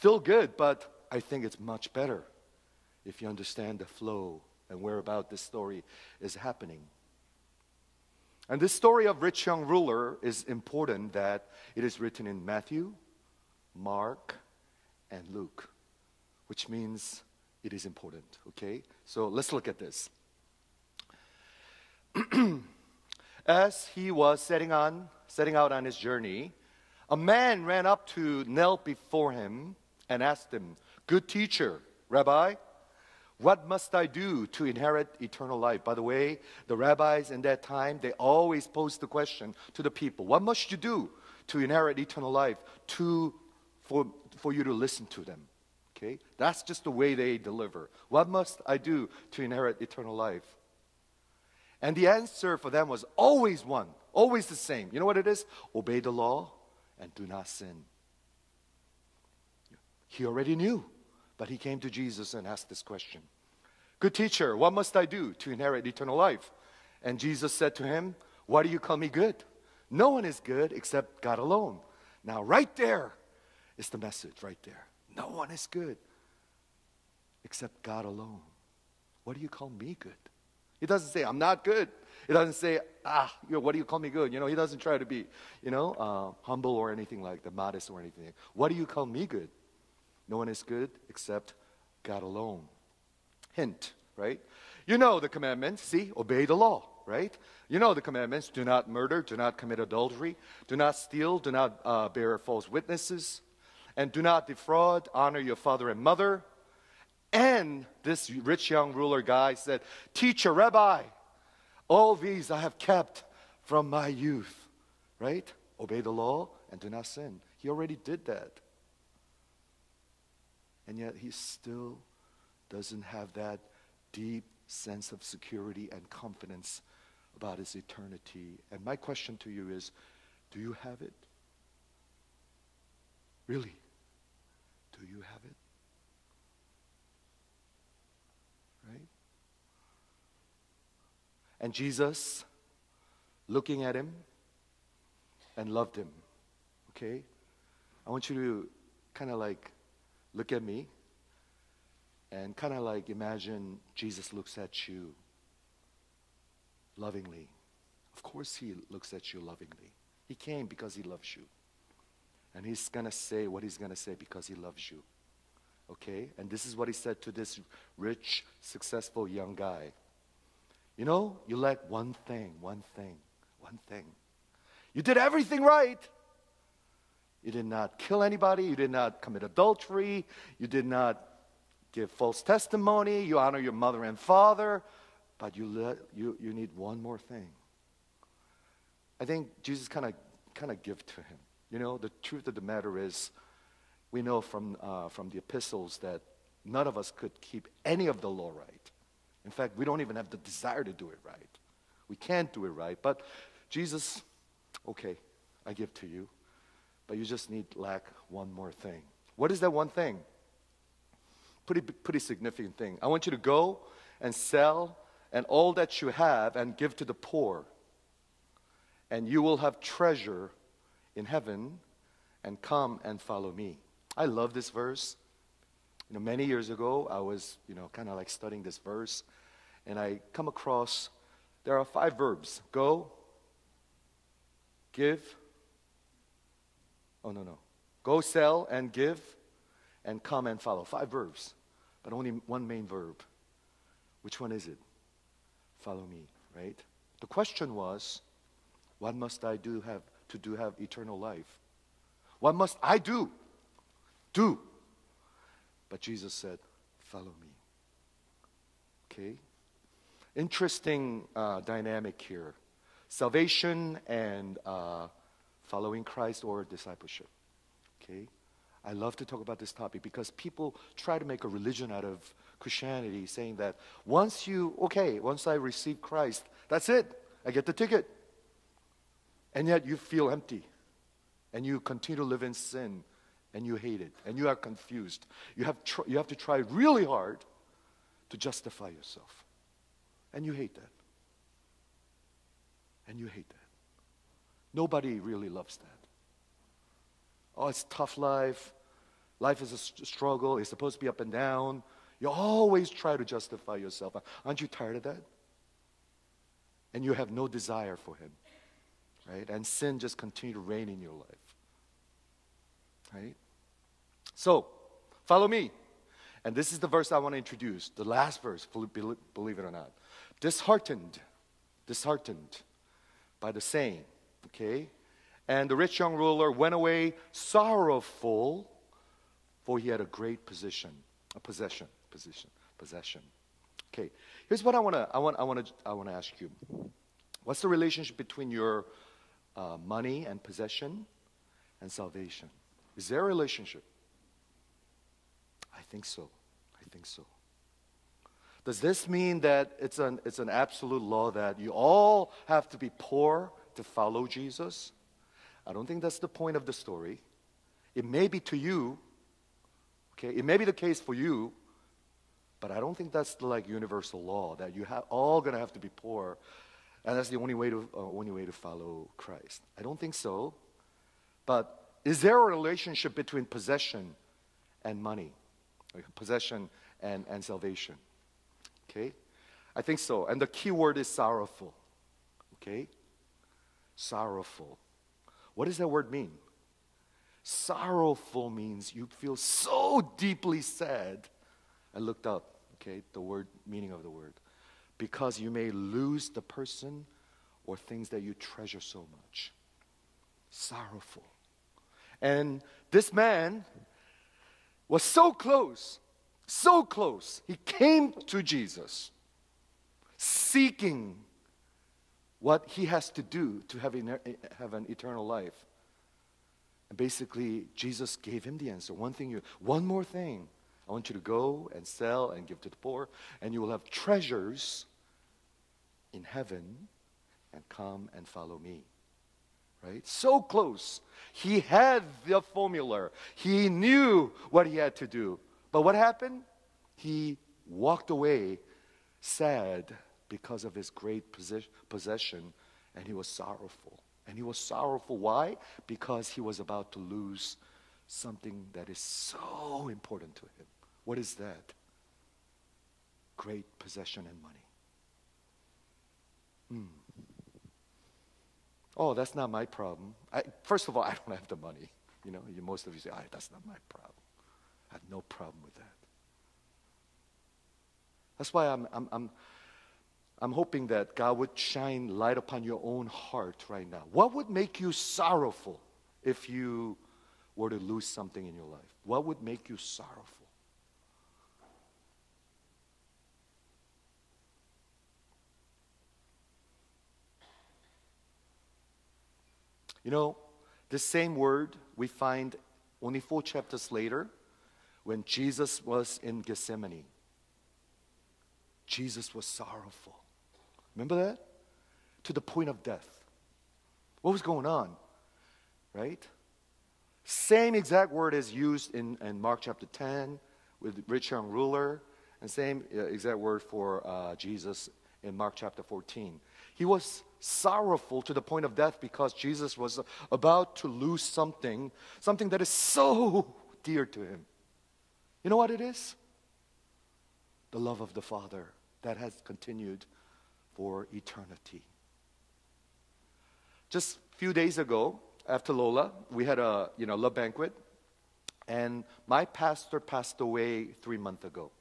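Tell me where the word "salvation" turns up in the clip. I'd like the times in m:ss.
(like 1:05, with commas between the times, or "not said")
4:23, 5:41, 6:17.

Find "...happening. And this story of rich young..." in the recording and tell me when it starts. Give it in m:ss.
0:06.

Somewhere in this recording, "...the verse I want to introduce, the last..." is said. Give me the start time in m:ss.
5:16.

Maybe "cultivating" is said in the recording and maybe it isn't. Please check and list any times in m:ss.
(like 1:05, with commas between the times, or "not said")
not said.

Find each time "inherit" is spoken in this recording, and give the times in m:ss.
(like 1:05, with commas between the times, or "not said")
0:34, 0:41, 0:49, 1:05.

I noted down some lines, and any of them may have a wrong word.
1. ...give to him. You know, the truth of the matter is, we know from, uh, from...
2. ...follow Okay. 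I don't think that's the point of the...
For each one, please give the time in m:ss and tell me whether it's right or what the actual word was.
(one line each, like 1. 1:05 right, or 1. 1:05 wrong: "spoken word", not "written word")
1. 3:10 right
2. 5:53 wrong: "Jesus", not "Okay".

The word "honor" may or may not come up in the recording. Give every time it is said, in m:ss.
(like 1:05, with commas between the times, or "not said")
1:45, 3:03.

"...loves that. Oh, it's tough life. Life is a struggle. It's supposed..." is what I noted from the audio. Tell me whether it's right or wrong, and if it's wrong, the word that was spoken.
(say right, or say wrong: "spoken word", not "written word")
right.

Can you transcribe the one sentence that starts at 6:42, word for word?
And this man was so close, so close.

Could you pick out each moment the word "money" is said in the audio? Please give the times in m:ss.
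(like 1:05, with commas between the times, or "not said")
5:39, 6:15, 7:34, 7:41.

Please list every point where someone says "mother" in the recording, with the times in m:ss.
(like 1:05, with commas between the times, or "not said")
1:45, 3:03.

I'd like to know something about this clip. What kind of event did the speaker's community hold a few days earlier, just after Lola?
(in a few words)
Love banquet.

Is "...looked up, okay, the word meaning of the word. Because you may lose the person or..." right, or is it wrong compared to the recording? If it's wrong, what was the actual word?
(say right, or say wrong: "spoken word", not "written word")
right.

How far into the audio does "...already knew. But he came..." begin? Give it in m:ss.
1:00.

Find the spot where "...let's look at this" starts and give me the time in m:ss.
0:19.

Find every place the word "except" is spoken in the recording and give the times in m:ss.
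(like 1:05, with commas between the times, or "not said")
1:10, 1:17, 1:31.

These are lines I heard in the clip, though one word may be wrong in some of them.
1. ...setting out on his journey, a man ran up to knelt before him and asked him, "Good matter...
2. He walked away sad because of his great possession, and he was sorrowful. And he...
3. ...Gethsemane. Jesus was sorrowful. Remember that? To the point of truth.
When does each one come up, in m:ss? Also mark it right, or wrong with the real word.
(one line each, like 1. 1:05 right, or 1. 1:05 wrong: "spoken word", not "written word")
1. 0:25 wrong: "teacher", not "matter"
2. 7:16 right
3. 8:16 wrong: "death", not "truth".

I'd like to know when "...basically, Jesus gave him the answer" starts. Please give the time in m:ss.
6:56.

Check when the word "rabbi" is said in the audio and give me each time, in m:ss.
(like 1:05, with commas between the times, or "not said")
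0:32, 0:36, 1:50.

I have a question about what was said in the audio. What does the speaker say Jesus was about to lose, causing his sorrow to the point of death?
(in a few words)
The love of the Father.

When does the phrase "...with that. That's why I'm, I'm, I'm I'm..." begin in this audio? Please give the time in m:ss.
7:45.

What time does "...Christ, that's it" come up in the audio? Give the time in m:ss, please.
4:36.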